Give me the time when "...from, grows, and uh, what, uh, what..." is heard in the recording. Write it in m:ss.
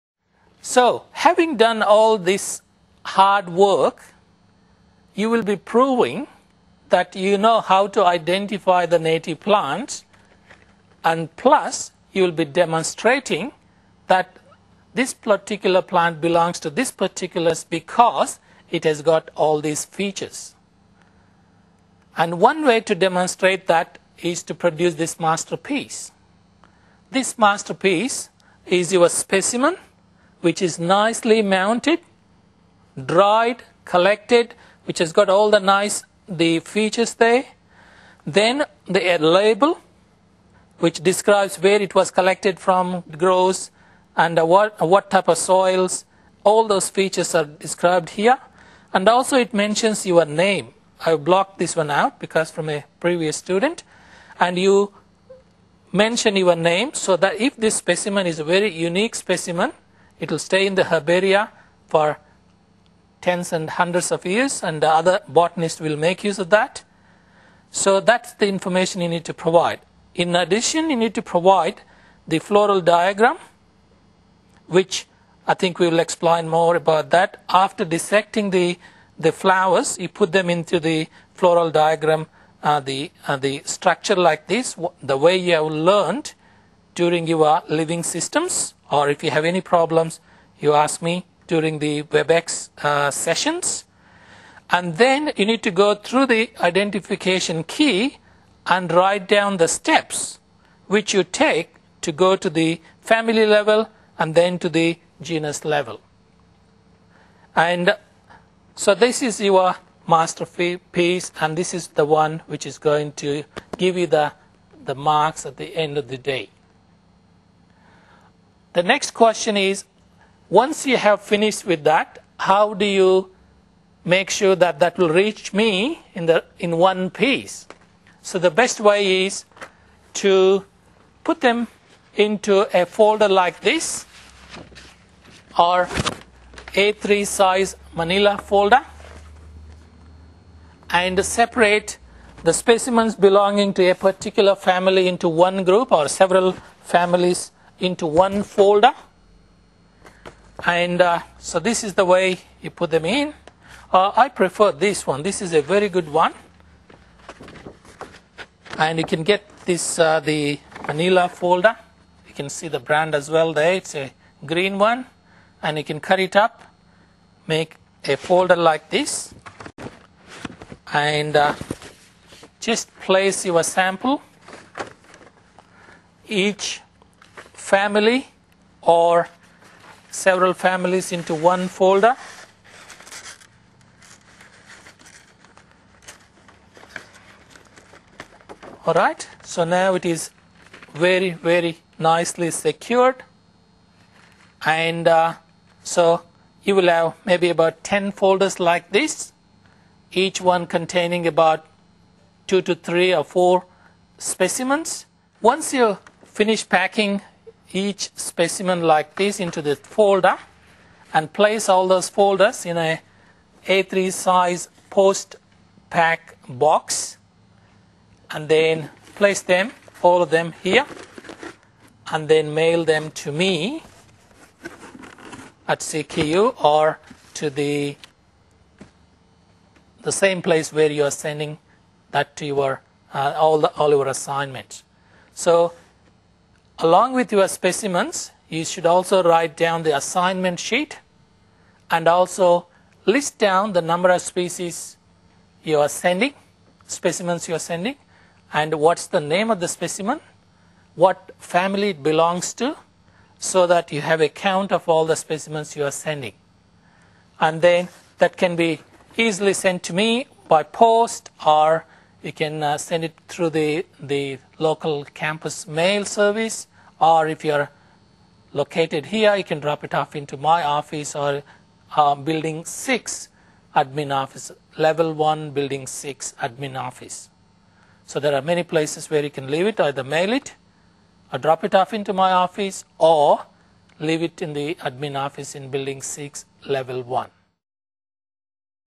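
0:42.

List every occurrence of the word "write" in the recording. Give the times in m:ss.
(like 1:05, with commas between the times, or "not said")
1:38, 3:59.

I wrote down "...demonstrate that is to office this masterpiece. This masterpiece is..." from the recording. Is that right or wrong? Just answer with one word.
wrong.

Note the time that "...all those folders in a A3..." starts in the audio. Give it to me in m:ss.
3:31.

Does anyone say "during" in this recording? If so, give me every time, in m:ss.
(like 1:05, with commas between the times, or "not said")
1:26, 1:31.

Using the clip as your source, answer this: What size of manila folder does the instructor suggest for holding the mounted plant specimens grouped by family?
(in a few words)
A3.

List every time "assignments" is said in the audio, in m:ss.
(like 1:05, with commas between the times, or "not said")
3:54, 3:59.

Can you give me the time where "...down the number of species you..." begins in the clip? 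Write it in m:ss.
4:03.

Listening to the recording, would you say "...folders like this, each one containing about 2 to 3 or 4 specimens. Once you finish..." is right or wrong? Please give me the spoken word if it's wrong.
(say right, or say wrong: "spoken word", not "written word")
right.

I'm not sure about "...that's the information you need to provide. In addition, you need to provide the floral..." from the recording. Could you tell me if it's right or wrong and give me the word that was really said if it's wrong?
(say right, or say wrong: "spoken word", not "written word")
right.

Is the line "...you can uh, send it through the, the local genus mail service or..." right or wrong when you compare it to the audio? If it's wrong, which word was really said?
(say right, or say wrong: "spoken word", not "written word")
wrong: "campus", not "genus".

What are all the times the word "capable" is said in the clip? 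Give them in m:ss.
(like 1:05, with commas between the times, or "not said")
not said.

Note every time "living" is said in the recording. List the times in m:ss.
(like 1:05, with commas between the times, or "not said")
1:27.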